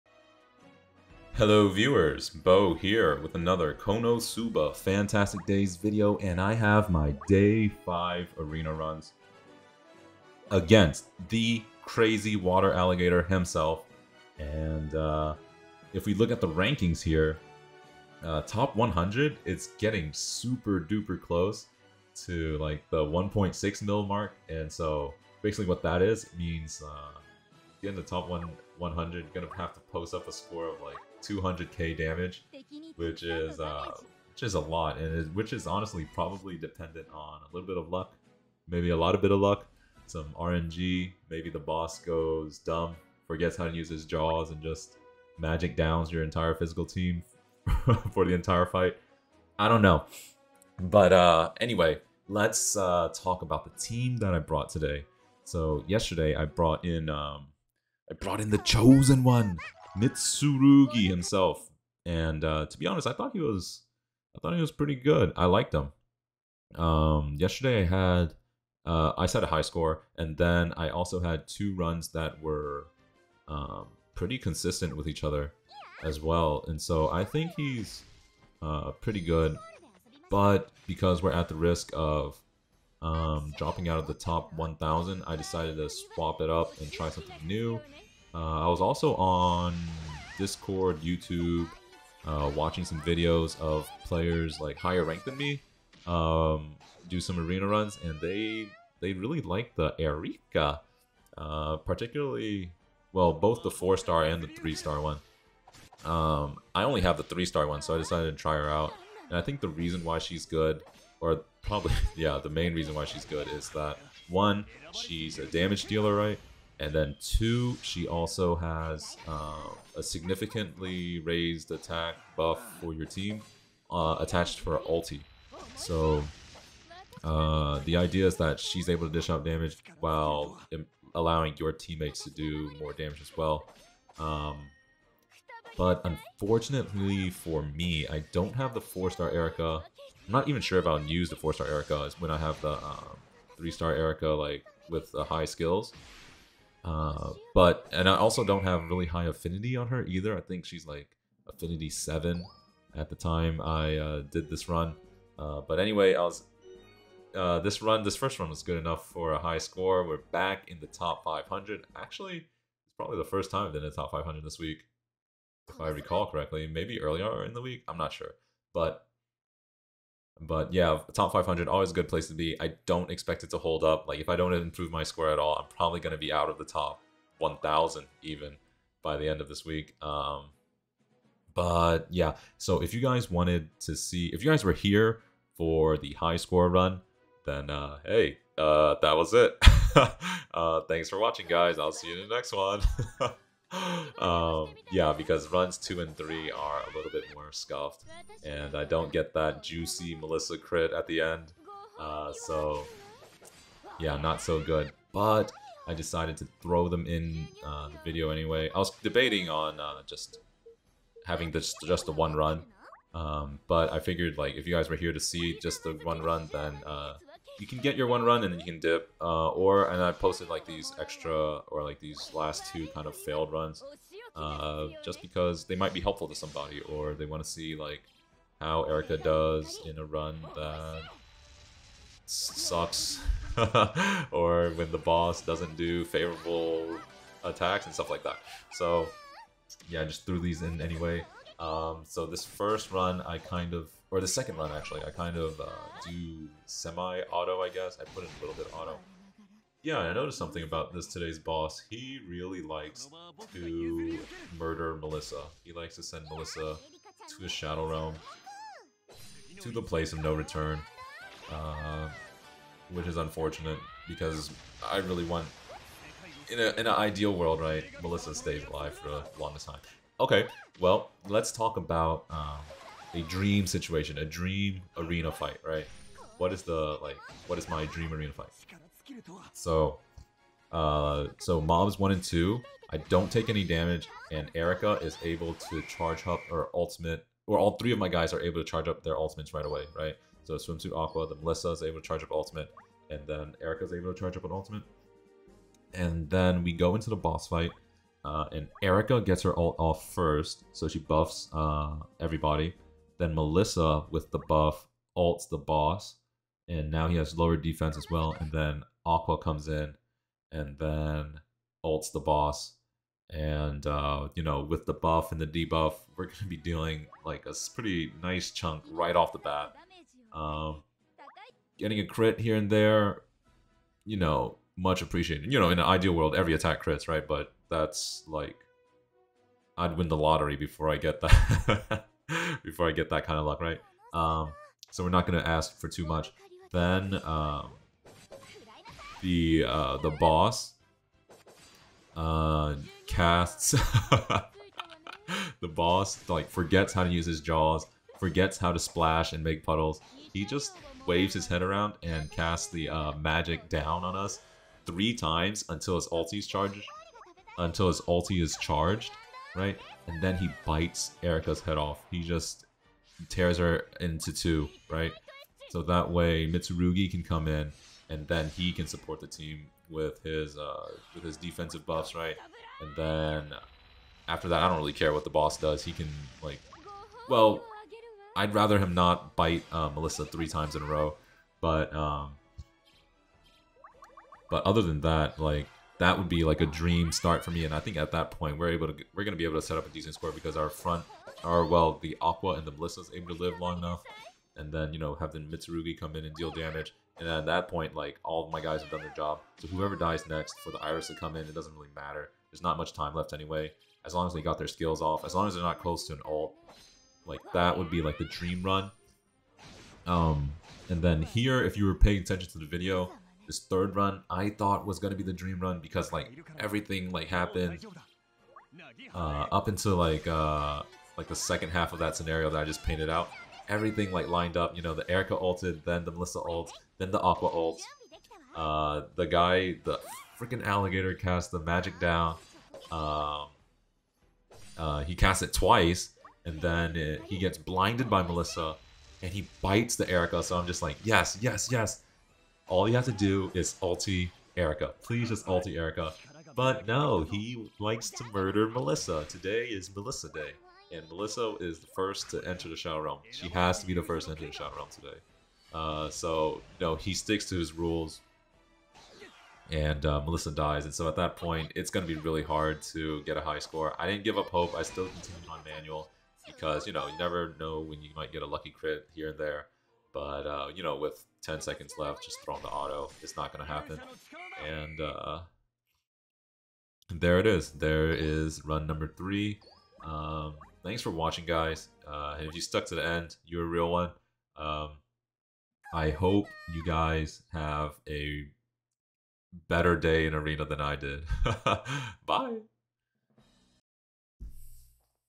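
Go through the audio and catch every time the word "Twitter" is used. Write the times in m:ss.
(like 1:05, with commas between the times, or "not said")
not said.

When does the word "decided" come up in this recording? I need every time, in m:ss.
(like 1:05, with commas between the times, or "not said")
1:25, 1:47, 3:25.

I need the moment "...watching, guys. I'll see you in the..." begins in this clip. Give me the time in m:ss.
3:11.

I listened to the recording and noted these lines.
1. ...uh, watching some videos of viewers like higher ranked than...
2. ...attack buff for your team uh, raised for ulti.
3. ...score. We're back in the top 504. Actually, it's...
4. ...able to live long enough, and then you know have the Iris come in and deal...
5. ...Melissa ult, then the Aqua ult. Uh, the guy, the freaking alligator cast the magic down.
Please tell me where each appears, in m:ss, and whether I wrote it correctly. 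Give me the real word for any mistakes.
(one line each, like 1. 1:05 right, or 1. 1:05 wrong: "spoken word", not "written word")
1. 1:32 wrong: "players", not "viewers"
2. 2:01 wrong: "attached", not "raised"
3. 2:39 wrong: "500", not "504"
4. 6:33 wrong: "Mitsurugi", not "Iris"
5. 7:06 right.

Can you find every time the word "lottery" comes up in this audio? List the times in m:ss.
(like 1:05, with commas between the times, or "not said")
5:30.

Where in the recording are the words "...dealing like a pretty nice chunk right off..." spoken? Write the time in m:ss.
5:16.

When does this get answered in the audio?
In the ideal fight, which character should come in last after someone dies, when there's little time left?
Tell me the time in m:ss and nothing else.
6:40.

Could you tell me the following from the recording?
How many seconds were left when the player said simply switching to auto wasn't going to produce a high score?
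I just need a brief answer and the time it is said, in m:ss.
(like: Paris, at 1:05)
10, at 7:51.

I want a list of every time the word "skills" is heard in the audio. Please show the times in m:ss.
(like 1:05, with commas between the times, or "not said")
2:25, 6:44.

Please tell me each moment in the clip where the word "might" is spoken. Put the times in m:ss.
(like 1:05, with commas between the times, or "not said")
3:45, 7:48.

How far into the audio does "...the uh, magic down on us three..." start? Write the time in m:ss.
5:52.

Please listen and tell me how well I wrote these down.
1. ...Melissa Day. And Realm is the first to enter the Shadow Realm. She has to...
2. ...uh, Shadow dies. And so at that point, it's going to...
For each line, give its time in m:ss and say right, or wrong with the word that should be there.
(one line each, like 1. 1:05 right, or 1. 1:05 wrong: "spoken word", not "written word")
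1. 7:29 wrong: "Melissa", not "Realm"
2. 7:40 wrong: "Melissa", not "Shadow".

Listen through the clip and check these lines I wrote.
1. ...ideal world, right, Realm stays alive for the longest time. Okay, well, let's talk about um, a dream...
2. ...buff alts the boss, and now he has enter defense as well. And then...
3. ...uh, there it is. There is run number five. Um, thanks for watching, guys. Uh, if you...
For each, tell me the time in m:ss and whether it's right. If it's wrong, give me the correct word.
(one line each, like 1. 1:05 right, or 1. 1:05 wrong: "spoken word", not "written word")
1. 4:26 wrong: "Melissa", not "Realm"
2. 5:04 wrong: "lower", not "enter"
3. 7:54 wrong: "three", not "five".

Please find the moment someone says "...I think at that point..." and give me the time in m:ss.
6:27.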